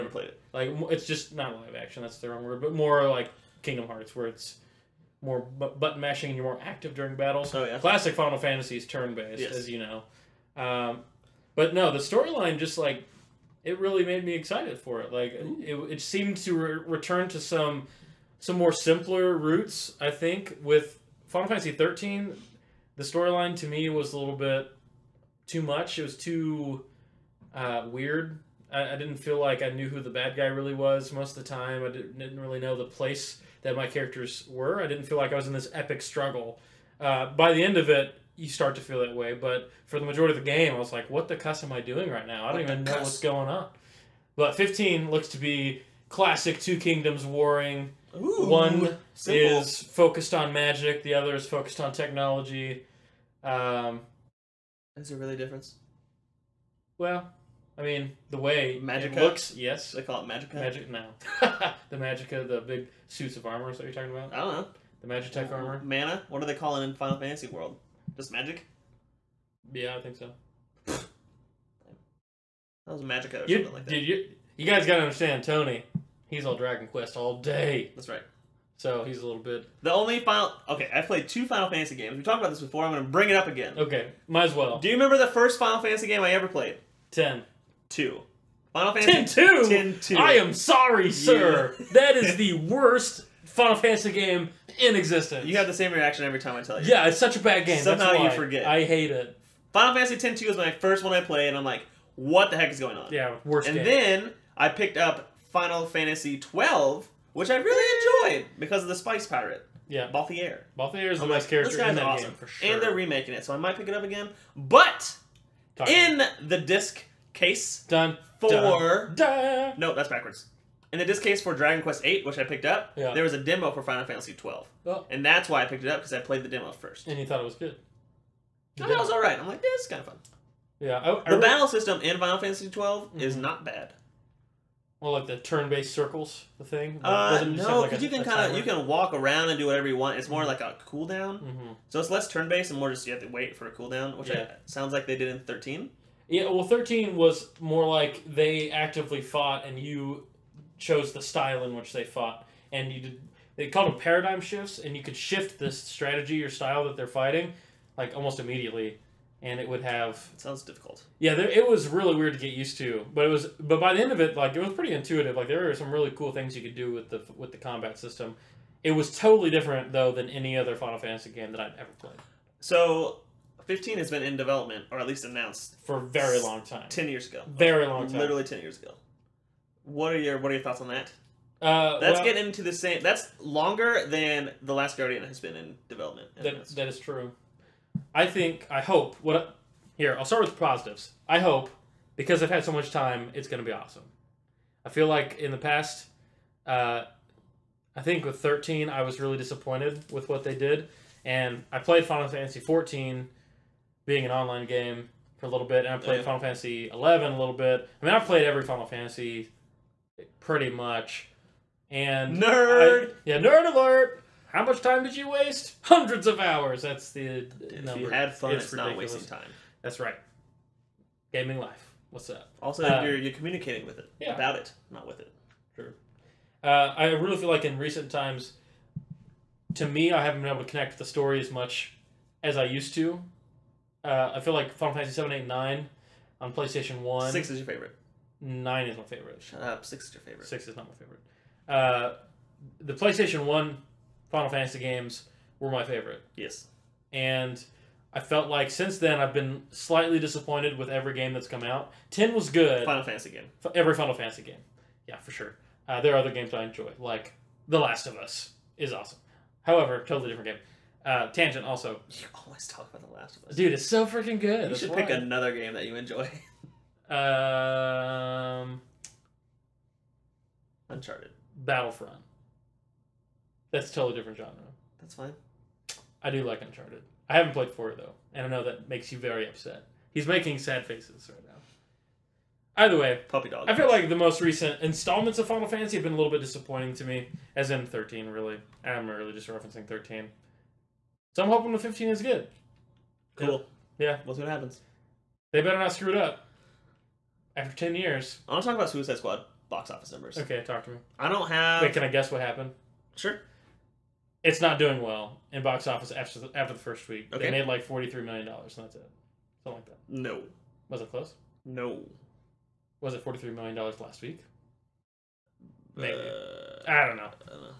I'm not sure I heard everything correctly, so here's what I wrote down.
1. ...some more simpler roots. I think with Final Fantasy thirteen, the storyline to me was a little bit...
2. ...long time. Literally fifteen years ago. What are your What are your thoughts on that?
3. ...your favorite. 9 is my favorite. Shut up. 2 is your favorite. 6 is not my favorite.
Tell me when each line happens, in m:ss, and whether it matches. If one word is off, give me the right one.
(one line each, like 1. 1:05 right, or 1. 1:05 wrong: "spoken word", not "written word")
1. 0:18 right
2. 2:57 wrong: "ten", not "fifteen"
3. 3:57 wrong: "6", not "2".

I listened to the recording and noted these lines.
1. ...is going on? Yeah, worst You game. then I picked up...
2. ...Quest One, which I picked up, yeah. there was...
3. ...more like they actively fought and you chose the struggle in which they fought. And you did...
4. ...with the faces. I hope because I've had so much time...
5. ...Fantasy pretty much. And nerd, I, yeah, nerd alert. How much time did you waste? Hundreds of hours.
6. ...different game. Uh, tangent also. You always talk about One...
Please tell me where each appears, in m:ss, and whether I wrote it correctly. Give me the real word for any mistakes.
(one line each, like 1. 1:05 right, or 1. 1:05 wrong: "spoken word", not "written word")
1. 1:42 wrong: "And", not "You"
2. 2:01 wrong: "VIII", not "One"
3. 2:27 wrong: "style", not "struggle"
4. 3:10 wrong: "positives", not "faces"
5. 3:28 right
6. 4:20 wrong: "The", not "One".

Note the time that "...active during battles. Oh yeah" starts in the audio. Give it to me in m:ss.
0:06.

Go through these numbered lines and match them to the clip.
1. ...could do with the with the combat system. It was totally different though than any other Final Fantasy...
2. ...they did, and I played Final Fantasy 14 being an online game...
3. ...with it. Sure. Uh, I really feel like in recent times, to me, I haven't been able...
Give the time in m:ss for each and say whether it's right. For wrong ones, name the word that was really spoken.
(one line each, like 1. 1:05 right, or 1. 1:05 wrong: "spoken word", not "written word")
1. 2:46 right
2. 3:20 right
3. 3:45 right.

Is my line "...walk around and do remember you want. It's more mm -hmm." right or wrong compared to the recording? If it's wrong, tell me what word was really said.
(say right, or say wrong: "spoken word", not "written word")
wrong: "whatever", not "remember".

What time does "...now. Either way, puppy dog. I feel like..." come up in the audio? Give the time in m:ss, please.
4:41.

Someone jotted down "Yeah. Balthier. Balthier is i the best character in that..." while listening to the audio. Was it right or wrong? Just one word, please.
right.